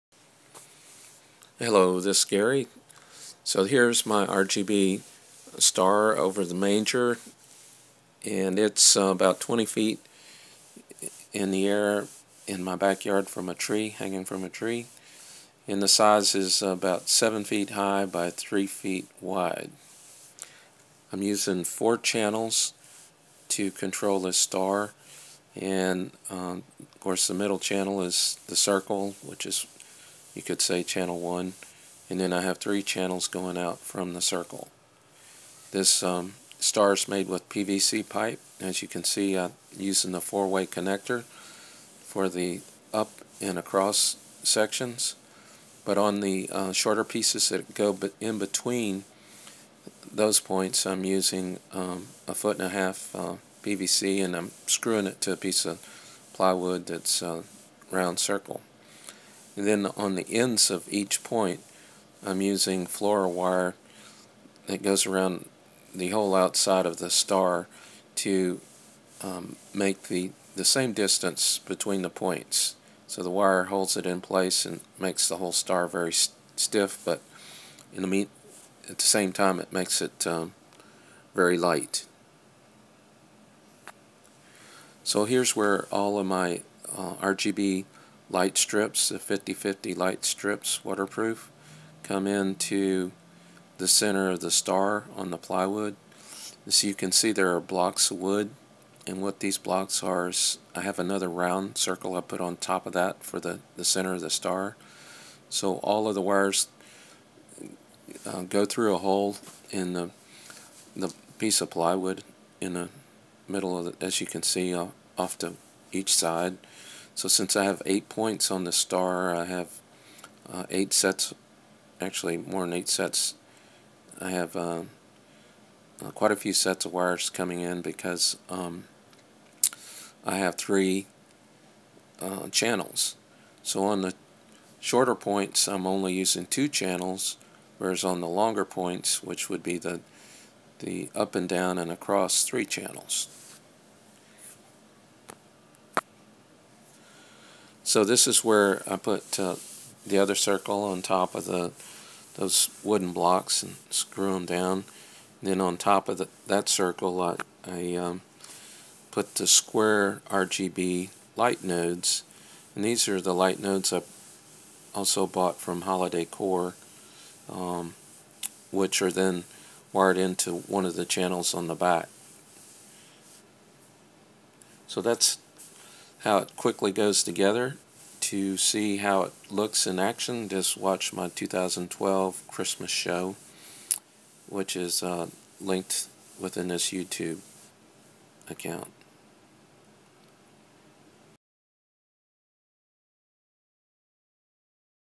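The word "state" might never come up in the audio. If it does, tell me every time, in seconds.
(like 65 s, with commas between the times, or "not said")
not said.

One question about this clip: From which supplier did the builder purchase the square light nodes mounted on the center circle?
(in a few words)
HolidayCoro.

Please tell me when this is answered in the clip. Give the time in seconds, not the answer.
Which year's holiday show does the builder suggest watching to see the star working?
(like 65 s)
181 s.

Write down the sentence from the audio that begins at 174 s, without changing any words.
So that's how it quickly goes together.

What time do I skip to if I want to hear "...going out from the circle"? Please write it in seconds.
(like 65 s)
33 s.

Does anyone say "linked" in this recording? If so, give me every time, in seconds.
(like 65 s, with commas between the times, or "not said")
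185 s.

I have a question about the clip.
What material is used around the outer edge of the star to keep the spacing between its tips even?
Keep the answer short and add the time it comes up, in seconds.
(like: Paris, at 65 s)
floral wire, at 62 s.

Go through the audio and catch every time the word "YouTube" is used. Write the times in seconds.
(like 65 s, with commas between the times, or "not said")
186 s.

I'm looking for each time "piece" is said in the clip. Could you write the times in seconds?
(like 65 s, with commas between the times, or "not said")
47 s, 55 s, 111 s.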